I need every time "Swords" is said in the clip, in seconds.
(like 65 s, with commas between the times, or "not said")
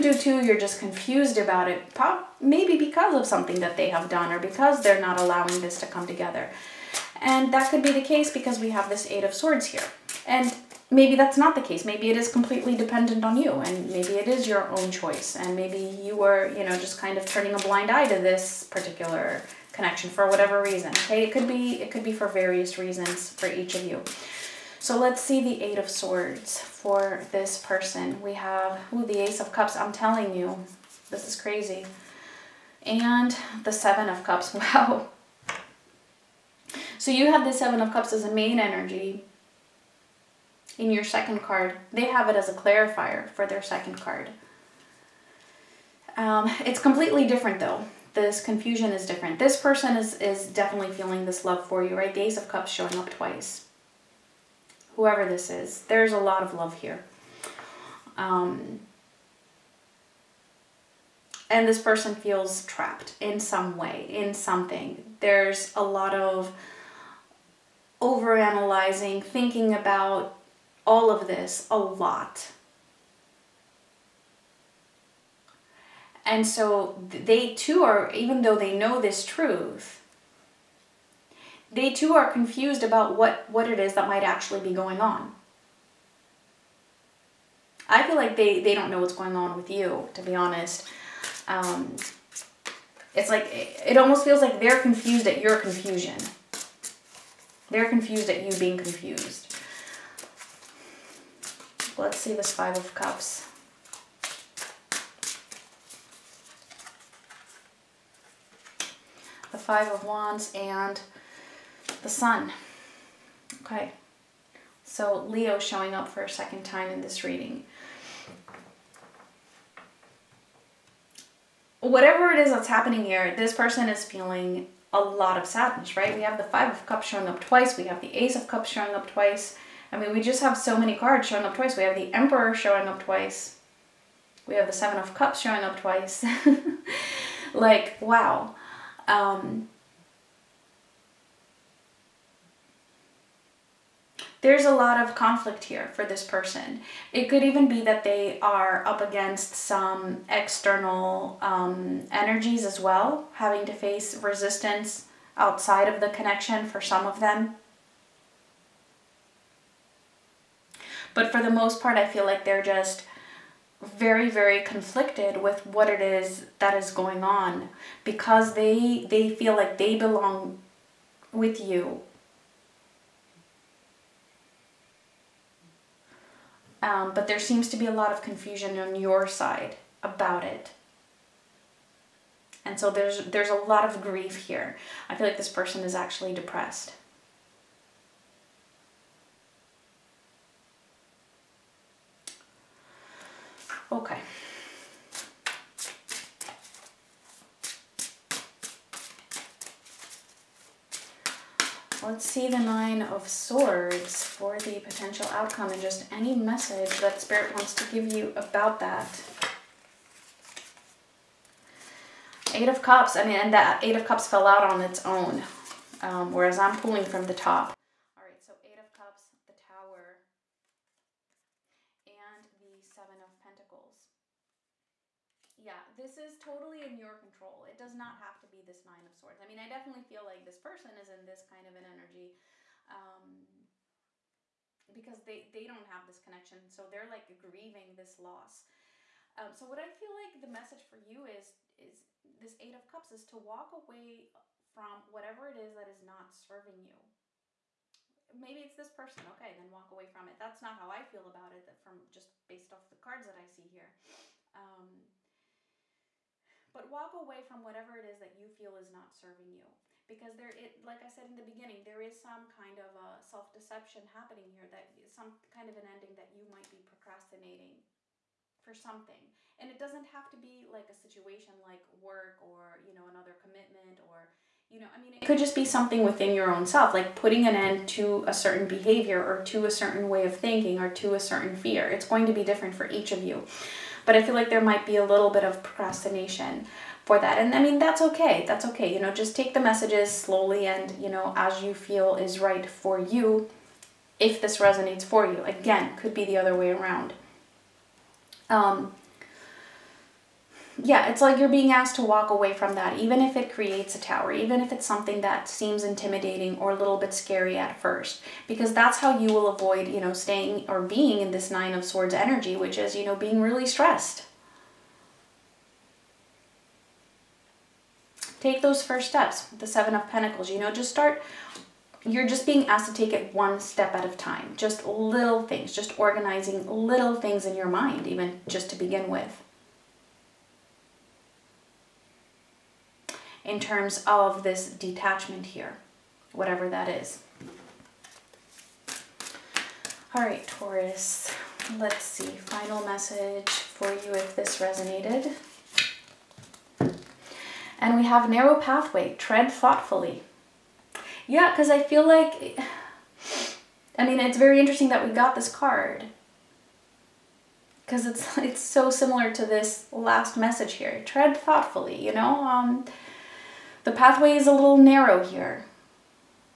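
9 s, 25 s, 203 s, 229 s, 311 s.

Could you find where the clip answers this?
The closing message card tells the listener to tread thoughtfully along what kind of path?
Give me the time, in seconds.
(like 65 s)
348 s.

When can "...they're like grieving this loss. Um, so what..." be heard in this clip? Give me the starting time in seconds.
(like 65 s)
236 s.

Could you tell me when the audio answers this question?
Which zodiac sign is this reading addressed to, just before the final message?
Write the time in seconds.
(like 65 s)
340 s.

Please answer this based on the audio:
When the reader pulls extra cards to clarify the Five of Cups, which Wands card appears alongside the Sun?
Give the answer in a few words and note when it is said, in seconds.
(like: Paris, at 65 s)
Five of Wands, at 109 s.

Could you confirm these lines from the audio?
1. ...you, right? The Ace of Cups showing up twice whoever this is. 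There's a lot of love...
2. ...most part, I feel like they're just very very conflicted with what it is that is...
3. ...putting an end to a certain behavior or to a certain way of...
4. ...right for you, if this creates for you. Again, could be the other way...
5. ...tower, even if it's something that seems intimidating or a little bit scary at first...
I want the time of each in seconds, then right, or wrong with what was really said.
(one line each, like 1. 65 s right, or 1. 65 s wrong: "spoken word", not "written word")
1. 51 s right
2. 161 s right
3. 277 s right
4. 292 s wrong: "resonates", not "creates"
5. 303 s right.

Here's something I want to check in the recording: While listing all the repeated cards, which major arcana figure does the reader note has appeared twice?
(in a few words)
The Emperor.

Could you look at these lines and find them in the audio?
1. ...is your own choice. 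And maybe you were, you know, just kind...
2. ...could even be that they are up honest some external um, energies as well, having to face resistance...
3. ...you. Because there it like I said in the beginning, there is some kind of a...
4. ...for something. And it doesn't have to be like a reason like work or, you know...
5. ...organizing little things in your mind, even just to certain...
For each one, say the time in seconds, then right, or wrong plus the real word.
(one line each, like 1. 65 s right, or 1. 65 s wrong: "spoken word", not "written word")
1. 14 s right
2. 147 s wrong: "against", not "honest"
3. 259 s right
4. 268 s wrong: "situation", not "reason"
5. 325 s wrong: "begin", not "certain".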